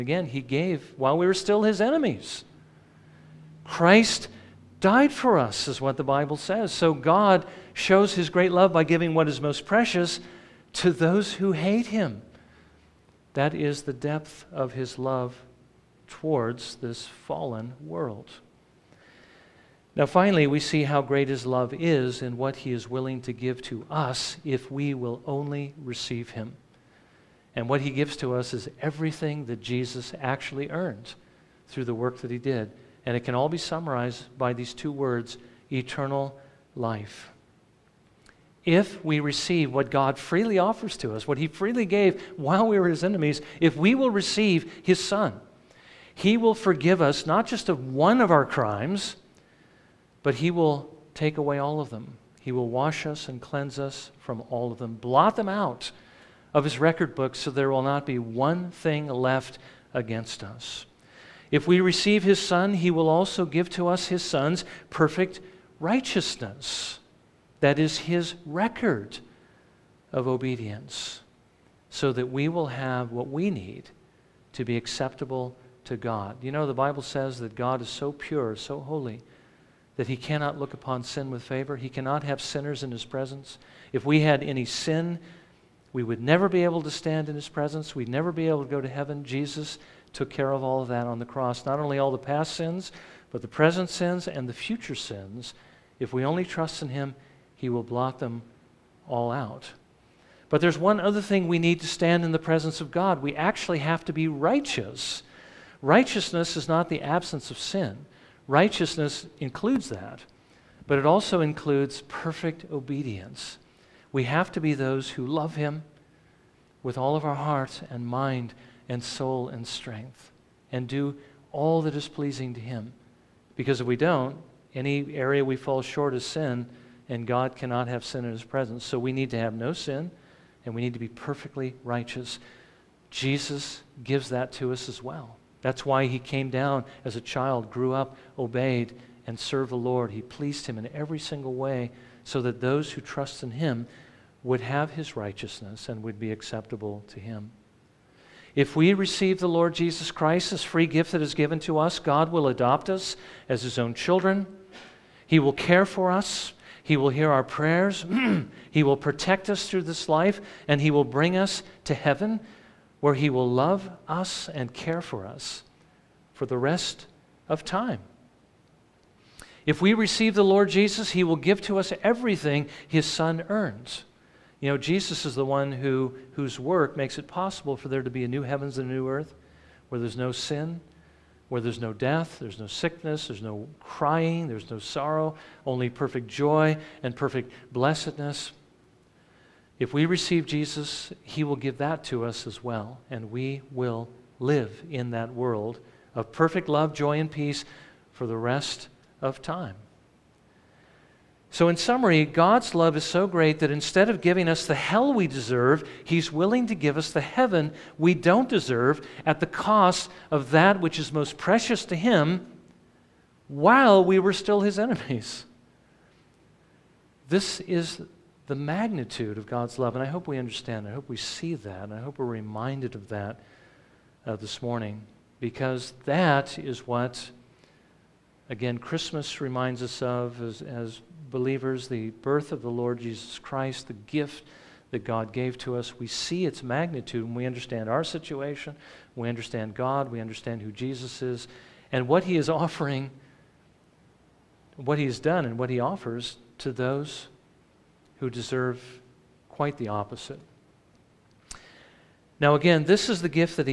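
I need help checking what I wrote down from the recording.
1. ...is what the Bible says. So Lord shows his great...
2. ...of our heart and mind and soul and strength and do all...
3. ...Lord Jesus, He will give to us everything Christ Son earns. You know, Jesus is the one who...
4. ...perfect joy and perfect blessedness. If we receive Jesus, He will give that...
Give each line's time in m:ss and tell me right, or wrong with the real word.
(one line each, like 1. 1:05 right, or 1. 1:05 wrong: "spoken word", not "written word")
1. 0:05 wrong: "God", not "Lord"
2. 1:57 right
3. 2:50 wrong: "His", not "Christ"
4. 3:05 right.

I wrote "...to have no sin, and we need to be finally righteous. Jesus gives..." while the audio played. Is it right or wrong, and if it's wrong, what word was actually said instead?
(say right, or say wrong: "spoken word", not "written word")
wrong: "perfectly", not "finally".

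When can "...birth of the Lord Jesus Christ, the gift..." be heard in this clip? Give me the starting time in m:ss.
3:52.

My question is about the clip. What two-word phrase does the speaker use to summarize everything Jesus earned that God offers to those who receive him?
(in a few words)
eternal life.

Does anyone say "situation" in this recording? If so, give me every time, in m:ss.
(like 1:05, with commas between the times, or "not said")
3:58.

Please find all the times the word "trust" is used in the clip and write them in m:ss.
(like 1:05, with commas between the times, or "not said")
1:36, 2:23.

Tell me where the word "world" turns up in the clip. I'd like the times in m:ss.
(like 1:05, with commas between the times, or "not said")
0:17, 3:15.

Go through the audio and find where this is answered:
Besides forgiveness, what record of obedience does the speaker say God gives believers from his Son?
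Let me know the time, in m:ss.
1:04.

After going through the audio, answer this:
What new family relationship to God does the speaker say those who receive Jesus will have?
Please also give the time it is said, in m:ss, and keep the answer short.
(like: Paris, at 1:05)
His own children, at 2:33.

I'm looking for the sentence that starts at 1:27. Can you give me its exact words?
We'd never be able to go to heaven.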